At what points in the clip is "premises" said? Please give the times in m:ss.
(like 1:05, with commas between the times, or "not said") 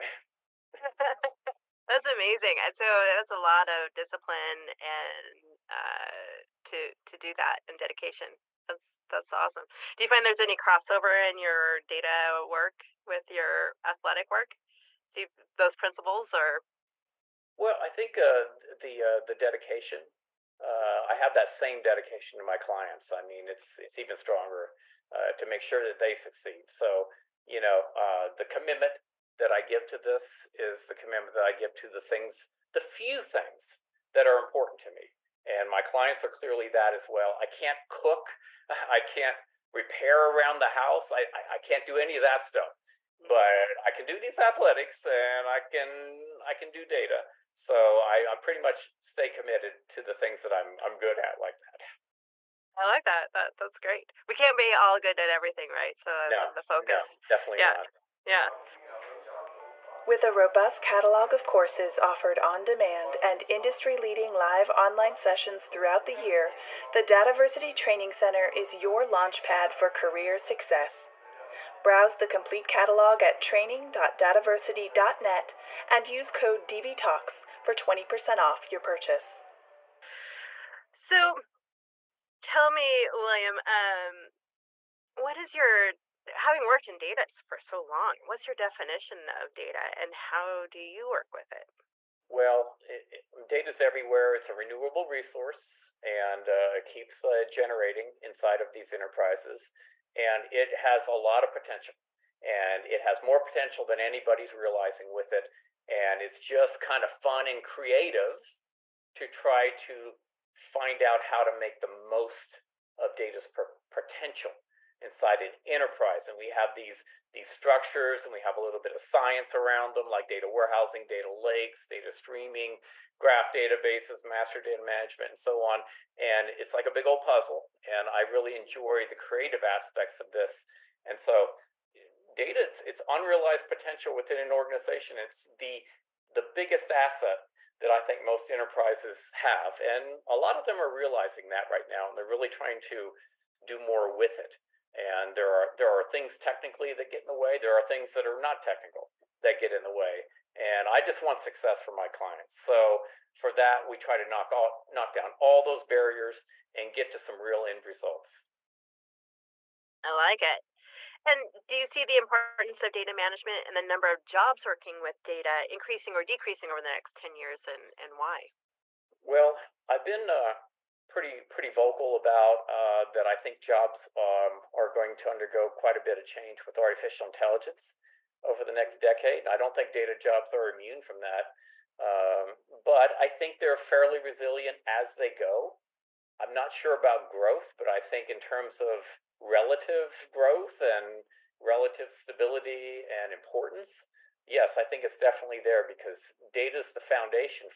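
not said.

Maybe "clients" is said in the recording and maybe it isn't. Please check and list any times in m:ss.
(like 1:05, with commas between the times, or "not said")
0:22, 0:35, 2:32.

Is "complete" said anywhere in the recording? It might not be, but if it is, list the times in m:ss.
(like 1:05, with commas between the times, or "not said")
1:12.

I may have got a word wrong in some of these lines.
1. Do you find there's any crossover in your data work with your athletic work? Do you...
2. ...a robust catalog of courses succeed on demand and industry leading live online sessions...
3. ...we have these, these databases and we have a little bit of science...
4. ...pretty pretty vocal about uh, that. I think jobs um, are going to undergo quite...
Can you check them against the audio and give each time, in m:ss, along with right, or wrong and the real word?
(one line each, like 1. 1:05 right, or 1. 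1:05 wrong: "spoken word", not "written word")
1. 0:09 right
2. 1:00 wrong: "offered", not "succeed"
3. 1:56 wrong: "structures", not "databases"
4. 2:51 right.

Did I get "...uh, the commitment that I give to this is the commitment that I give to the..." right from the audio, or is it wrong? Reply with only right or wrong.
right.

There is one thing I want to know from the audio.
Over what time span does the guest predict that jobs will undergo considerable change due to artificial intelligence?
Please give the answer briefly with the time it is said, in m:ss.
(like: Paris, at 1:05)
next decade, at 2:58.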